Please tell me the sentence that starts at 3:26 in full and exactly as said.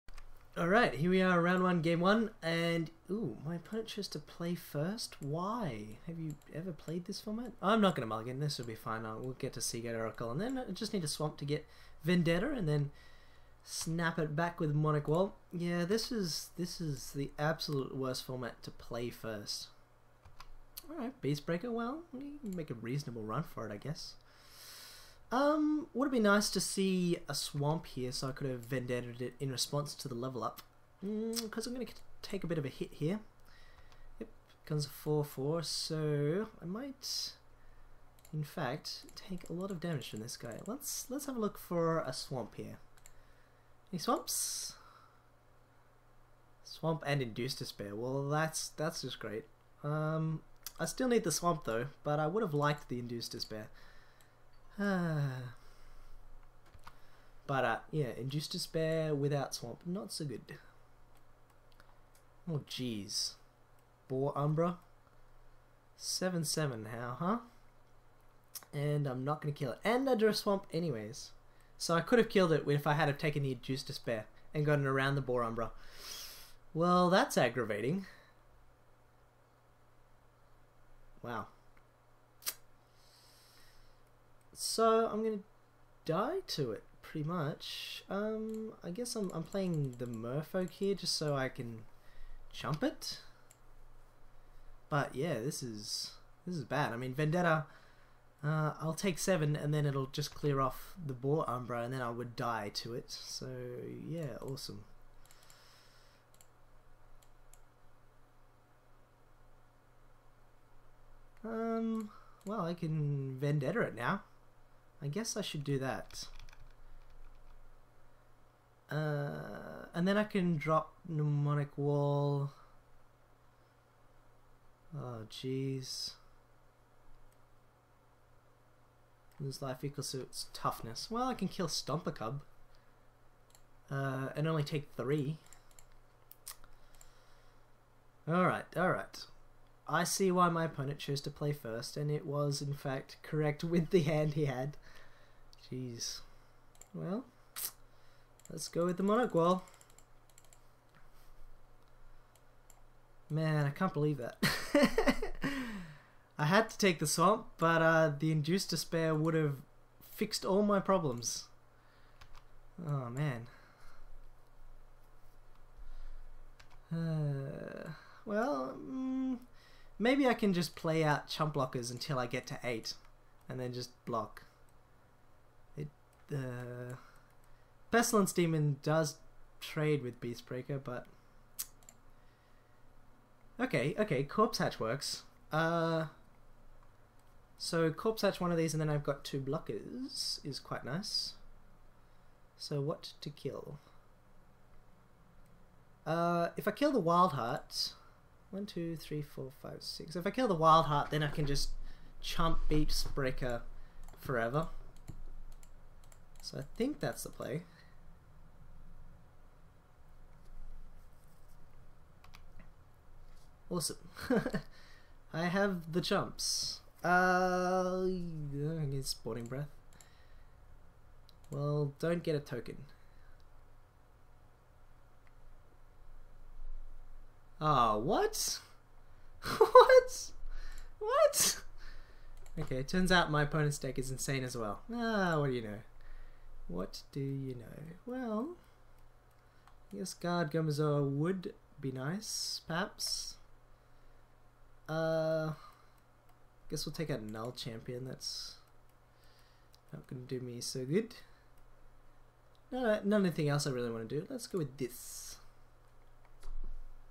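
So I think that's the play.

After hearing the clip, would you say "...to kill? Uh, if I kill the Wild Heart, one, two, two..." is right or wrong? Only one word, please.
wrong.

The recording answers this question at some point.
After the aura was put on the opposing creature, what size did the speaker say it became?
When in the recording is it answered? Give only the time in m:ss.
1:05.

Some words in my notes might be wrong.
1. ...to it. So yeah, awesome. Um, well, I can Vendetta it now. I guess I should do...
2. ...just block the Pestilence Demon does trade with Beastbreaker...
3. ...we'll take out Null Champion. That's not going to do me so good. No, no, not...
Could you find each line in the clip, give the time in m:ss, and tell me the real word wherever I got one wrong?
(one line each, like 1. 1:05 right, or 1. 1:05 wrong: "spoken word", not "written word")
1. 1:42 right
2. 2:53 right
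3. 4:06 right.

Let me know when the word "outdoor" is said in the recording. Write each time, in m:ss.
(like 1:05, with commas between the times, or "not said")
not said.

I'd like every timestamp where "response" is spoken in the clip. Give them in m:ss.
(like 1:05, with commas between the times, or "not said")
0:29.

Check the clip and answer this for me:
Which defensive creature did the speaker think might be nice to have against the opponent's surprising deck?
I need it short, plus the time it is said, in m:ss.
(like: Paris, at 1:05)
Guard Gomazoa, at 4:00.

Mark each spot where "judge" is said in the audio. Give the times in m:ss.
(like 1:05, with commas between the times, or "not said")
not said.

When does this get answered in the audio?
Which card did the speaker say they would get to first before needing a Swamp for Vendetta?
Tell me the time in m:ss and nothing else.
0:09.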